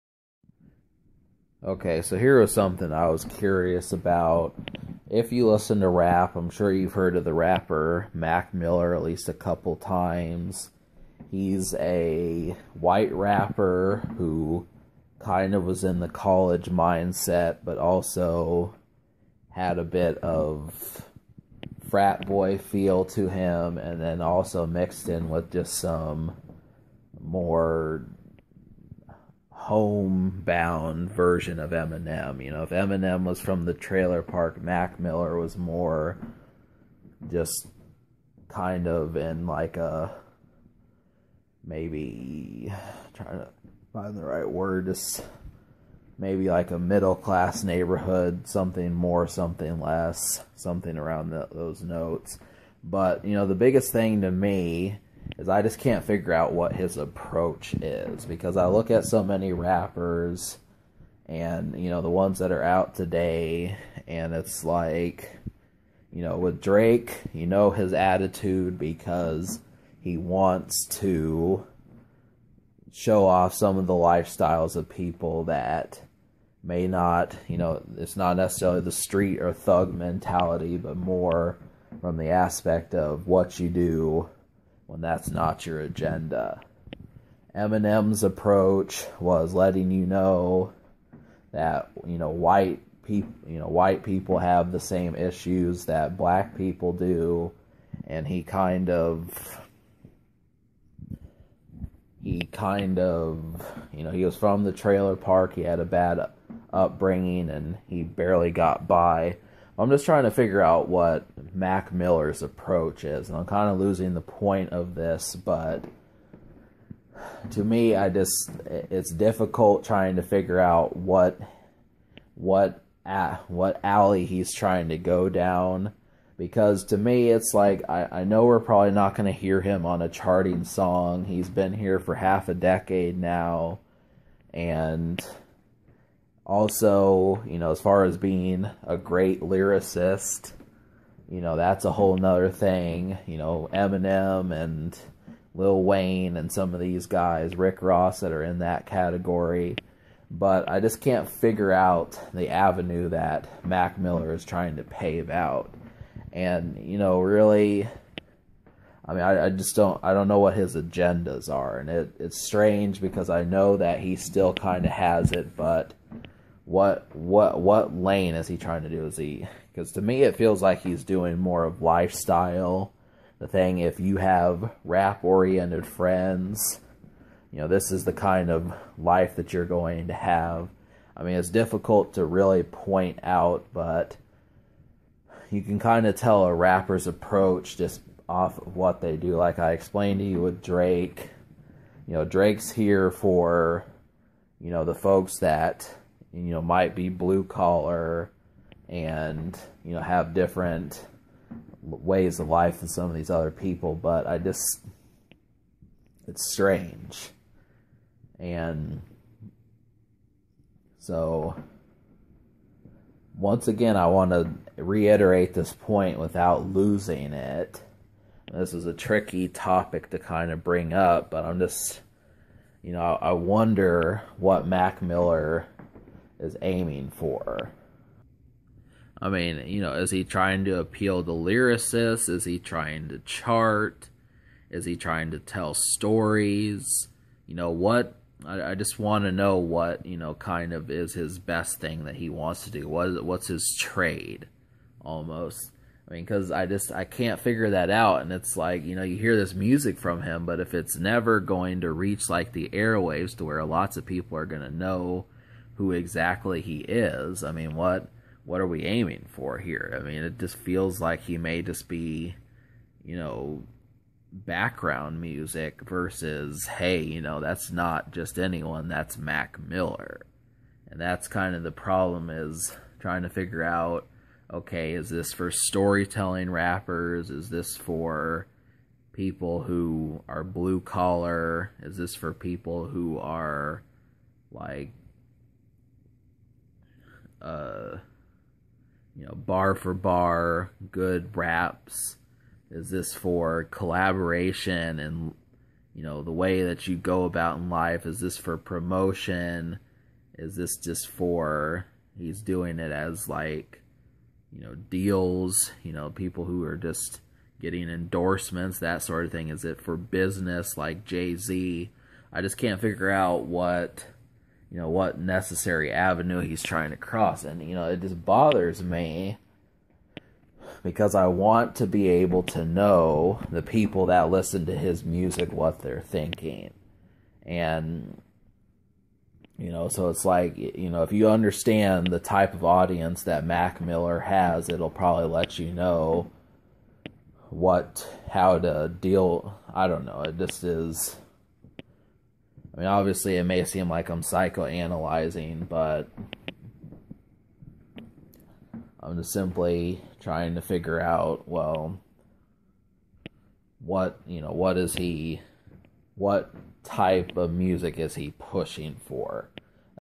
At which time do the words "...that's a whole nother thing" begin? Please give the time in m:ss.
2:21.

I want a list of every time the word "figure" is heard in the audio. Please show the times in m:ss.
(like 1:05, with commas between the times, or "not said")
0:56, 1:50, 2:00, 2:31, 4:07, 4:33, 5:12, 5:50.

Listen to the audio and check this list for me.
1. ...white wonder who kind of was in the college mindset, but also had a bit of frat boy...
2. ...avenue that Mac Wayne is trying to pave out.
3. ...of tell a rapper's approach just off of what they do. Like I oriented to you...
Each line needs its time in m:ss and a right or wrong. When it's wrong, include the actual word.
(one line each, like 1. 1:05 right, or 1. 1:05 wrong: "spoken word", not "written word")
1. 0:12 wrong: "rapper", not "wonder"
2. 2:32 wrong: "Miller", not "Wayne"
3. 3:06 wrong: "explained", not "oriented".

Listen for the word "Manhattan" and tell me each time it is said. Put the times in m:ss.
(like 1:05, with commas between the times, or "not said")
not said.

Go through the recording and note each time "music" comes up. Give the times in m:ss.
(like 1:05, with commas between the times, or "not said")
4:09, 4:25, 5:25, 5:57.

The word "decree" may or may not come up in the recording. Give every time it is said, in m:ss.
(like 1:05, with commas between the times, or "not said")
not said.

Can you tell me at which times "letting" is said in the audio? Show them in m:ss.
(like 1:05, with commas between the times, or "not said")
1:29.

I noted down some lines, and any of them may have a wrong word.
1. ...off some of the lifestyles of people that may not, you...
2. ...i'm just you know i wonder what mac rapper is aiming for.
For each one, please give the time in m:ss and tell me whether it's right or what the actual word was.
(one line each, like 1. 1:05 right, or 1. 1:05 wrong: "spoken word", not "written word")
1. 1:13 right
2. 3:41 wrong: "miller", not "rapper".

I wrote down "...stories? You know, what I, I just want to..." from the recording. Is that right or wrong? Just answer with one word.
right.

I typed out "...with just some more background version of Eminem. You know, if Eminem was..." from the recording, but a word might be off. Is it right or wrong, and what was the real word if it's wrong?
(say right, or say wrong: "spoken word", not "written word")
wrong: "homebound", not "background".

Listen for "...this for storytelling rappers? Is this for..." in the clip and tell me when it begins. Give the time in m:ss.
4:35.